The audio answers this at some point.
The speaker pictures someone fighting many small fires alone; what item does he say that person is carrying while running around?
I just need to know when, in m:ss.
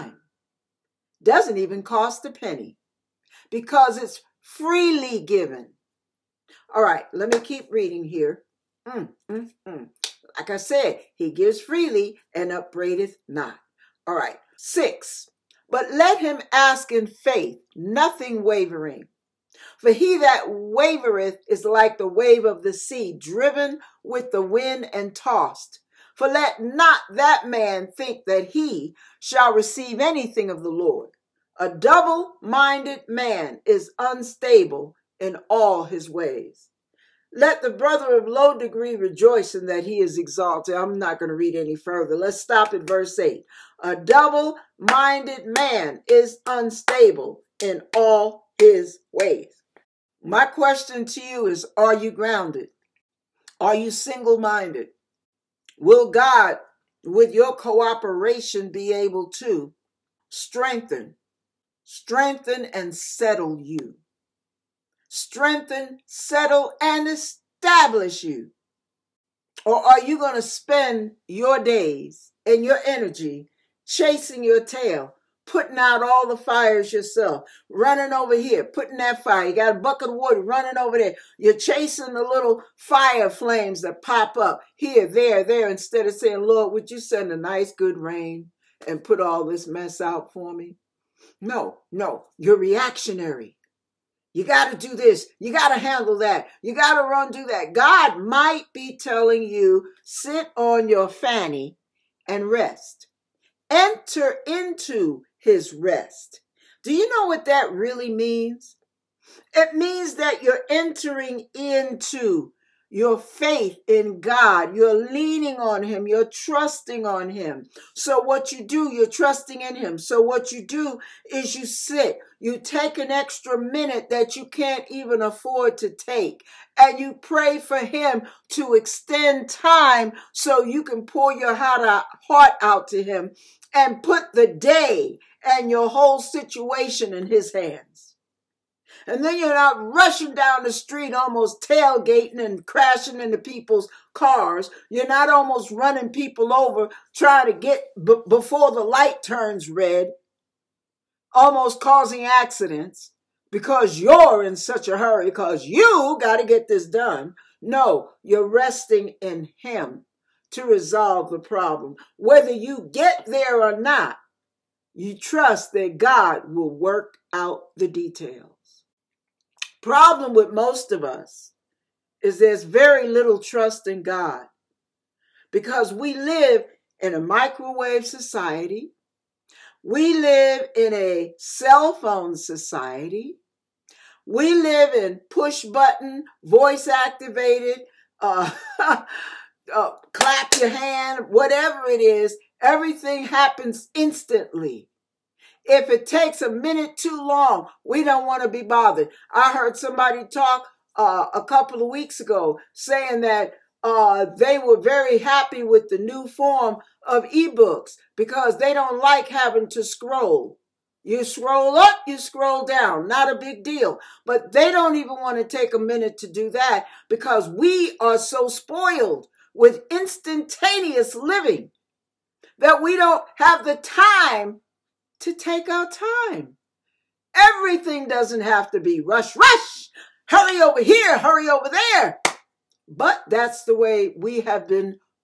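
1:19.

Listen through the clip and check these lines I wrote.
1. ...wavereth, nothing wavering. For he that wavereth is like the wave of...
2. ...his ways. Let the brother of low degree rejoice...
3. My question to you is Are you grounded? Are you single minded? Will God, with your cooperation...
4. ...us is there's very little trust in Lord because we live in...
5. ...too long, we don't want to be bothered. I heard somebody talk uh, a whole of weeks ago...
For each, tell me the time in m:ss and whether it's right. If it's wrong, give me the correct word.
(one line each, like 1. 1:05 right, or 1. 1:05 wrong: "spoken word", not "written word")
1. 0:17 wrong: "faith", not "wavereth"
2. 0:35 right
3. 0:50 right
4. 2:51 wrong: "God", not "Lord"
5. 3:16 wrong: "couple", not "whole".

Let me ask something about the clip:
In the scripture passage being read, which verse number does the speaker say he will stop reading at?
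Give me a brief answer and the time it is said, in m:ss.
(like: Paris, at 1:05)
8, at 0:42.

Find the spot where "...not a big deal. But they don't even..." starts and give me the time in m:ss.
3:33.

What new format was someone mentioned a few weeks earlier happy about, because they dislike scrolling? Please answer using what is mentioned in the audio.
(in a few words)
ebooks.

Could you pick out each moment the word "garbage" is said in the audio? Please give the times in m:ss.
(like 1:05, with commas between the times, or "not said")
not said.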